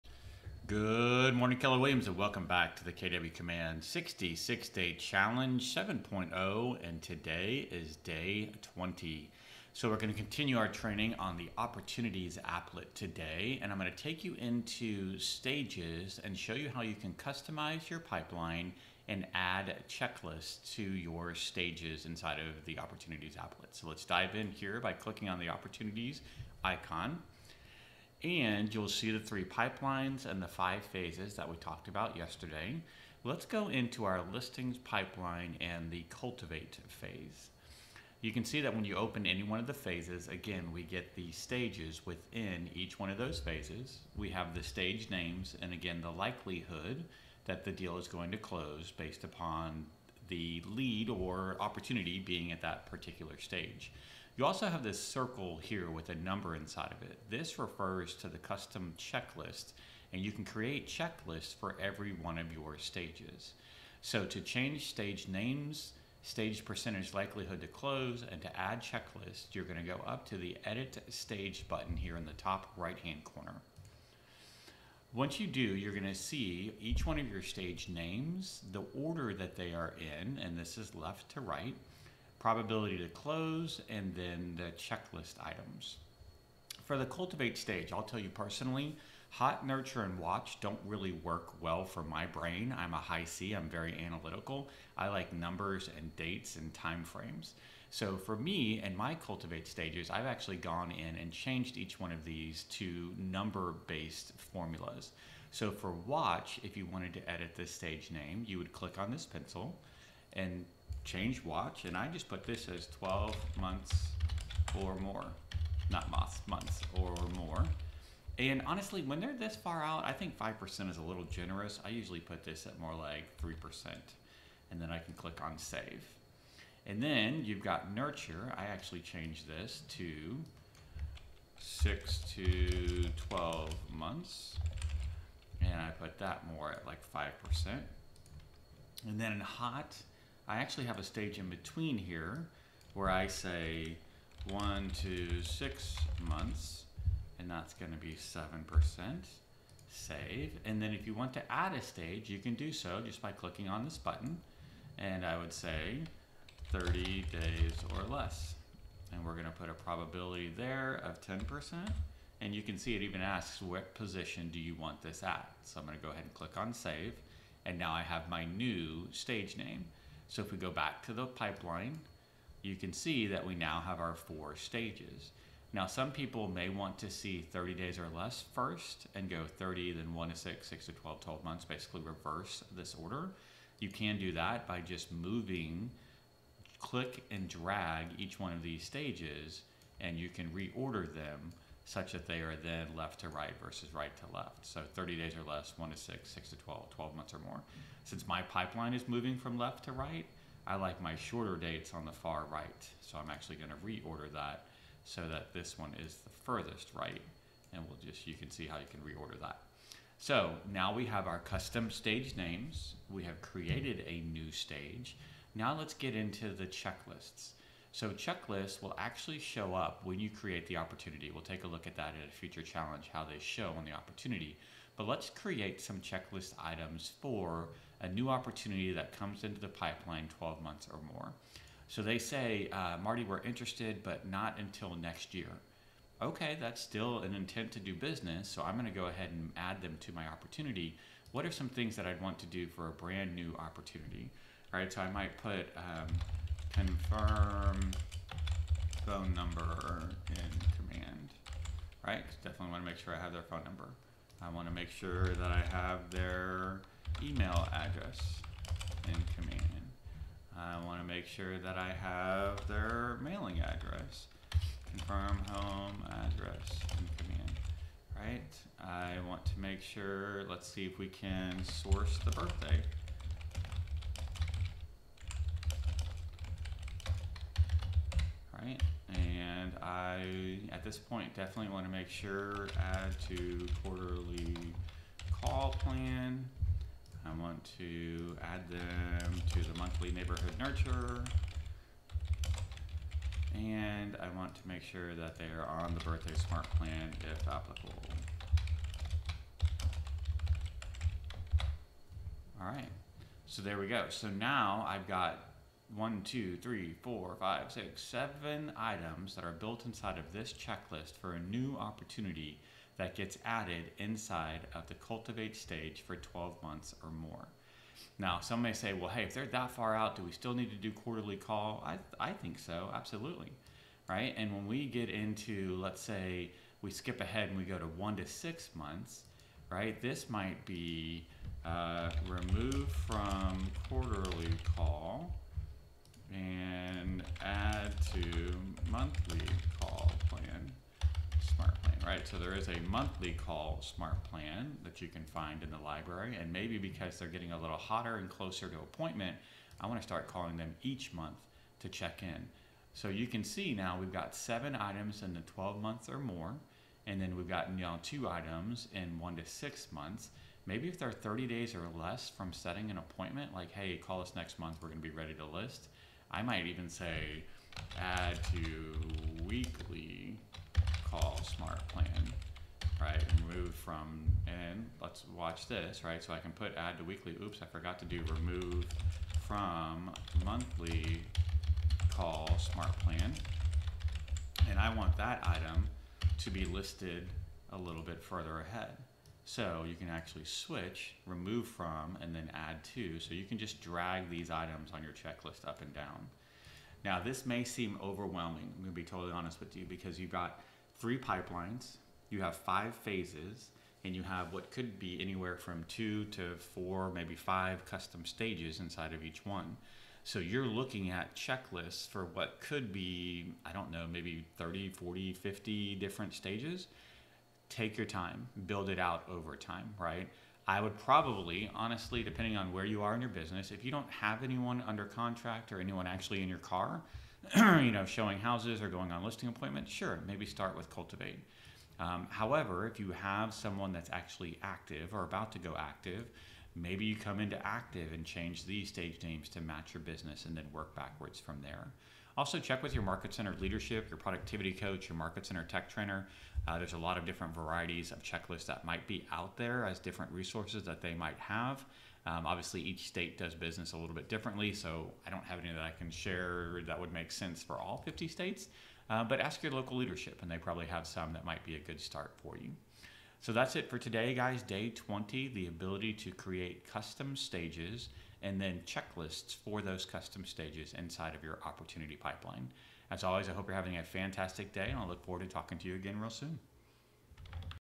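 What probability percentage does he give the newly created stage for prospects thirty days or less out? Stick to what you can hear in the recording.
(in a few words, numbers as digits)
10%.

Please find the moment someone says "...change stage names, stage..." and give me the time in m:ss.
1:04.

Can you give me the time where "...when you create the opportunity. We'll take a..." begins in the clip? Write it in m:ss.
3:40.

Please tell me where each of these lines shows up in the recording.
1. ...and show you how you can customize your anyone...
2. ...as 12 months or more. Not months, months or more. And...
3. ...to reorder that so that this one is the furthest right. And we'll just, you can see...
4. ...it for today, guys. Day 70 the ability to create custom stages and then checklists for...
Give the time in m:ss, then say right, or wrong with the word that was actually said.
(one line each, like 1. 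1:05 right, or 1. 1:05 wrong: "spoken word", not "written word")
1. 0:16 wrong: "pipeline", not "anyone"
2. 1:52 right
3. 3:23 right
4. 7:43 wrong: "20", not "70".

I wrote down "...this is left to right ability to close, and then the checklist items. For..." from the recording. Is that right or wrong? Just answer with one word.
wrong.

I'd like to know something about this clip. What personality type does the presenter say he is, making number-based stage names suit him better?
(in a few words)
high C.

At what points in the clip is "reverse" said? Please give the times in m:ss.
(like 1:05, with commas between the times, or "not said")
3:02.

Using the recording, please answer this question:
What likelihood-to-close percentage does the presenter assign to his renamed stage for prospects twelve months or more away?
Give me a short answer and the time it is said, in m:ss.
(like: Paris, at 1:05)
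3%, at 2:03.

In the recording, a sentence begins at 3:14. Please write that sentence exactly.
So 30 days or less, 1 to 6, 6 to 12, 12 months or more.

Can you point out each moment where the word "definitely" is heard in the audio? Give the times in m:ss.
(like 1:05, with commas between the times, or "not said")
4:12, 4:41.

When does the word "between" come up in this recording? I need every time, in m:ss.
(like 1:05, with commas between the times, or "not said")
2:21.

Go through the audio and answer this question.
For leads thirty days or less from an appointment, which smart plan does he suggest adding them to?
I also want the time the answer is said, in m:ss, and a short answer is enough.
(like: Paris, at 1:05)
weekly call smart plan, at 6:09.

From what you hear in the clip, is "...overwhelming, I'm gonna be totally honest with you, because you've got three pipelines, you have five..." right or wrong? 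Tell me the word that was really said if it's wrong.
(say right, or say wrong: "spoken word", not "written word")
right.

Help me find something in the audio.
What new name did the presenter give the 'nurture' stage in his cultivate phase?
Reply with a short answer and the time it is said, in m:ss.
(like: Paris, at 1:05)
6 to 12 months, at 2:11.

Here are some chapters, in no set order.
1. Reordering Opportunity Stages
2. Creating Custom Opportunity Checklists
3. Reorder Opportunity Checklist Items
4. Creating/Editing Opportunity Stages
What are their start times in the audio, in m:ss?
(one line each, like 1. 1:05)
1. 3:01
2. 3:45
3. 6:28
4. 1:10.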